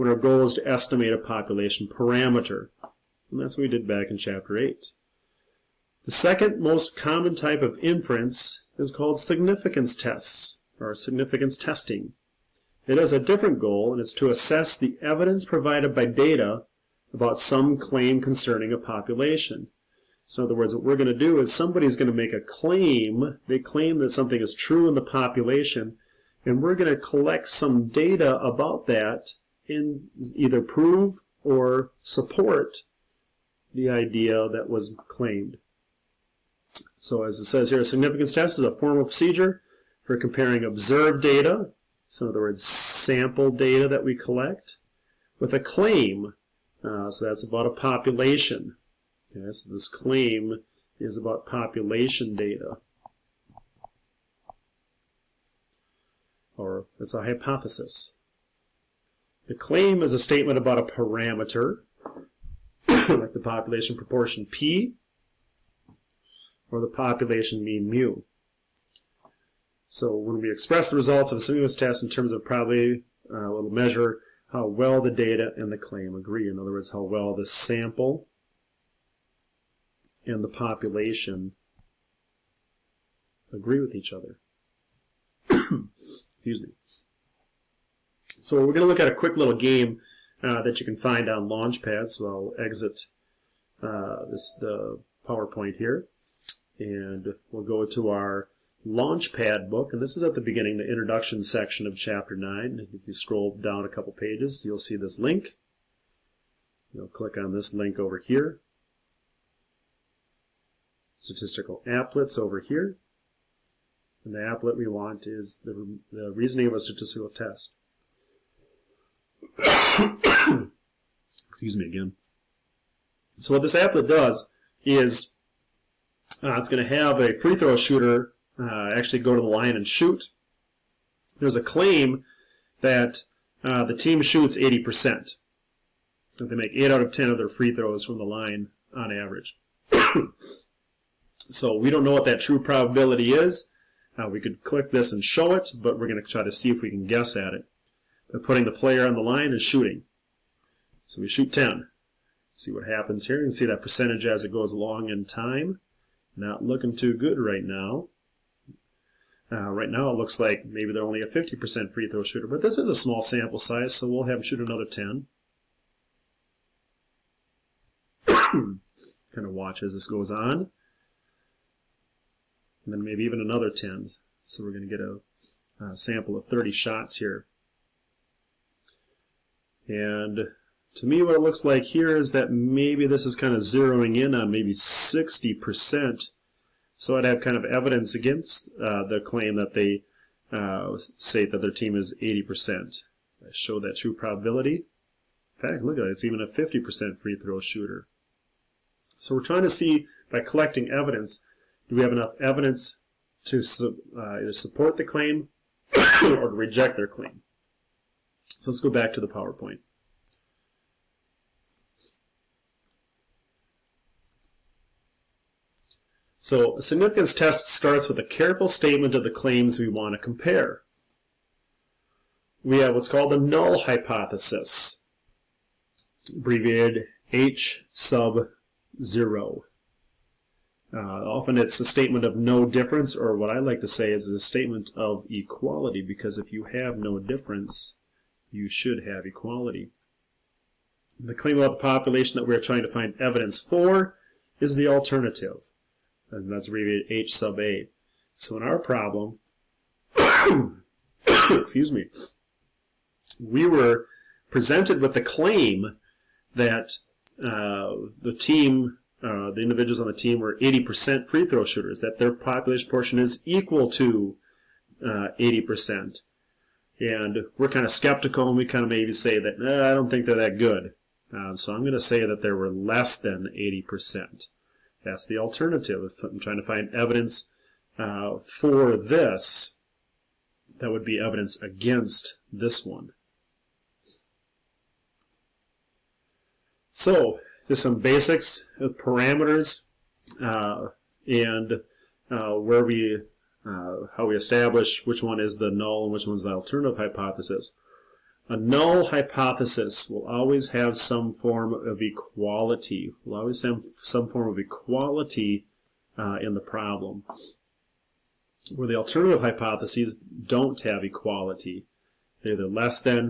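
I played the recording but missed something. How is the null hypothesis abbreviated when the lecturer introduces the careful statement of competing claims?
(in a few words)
H sub 0.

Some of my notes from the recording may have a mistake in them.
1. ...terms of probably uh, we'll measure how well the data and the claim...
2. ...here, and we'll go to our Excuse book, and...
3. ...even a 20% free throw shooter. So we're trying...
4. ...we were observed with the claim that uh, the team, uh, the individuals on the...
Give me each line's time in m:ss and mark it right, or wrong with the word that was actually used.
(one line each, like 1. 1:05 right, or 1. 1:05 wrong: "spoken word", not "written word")
1. 1:12 right
2. 1:35 wrong: "Launchpad", not "Excuse"
3. 3:16 wrong: "50", not "20"
4. 4:13 wrong: "presented", not "observed".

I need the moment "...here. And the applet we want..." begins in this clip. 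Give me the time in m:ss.
1:52.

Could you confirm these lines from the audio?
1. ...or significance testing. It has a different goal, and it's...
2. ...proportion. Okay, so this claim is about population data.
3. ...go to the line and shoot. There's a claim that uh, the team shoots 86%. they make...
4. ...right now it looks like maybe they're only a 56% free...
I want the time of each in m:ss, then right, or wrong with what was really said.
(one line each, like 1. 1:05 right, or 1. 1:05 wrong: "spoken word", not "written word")
1. 0:10 right
2. 0:47 wrong: "population", not "proportion"
3. 2:09 wrong: "80", not "86"
4. 2:39 wrong: "50", not "56".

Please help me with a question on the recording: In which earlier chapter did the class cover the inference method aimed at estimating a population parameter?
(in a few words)
Chapter 8.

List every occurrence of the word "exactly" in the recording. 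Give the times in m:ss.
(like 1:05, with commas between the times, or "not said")
not said.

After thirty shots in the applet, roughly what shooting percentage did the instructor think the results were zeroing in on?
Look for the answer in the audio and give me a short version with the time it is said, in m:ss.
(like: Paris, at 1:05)
60%, at 3:04.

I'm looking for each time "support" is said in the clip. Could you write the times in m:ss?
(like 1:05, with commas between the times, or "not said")
0:32, 3:24.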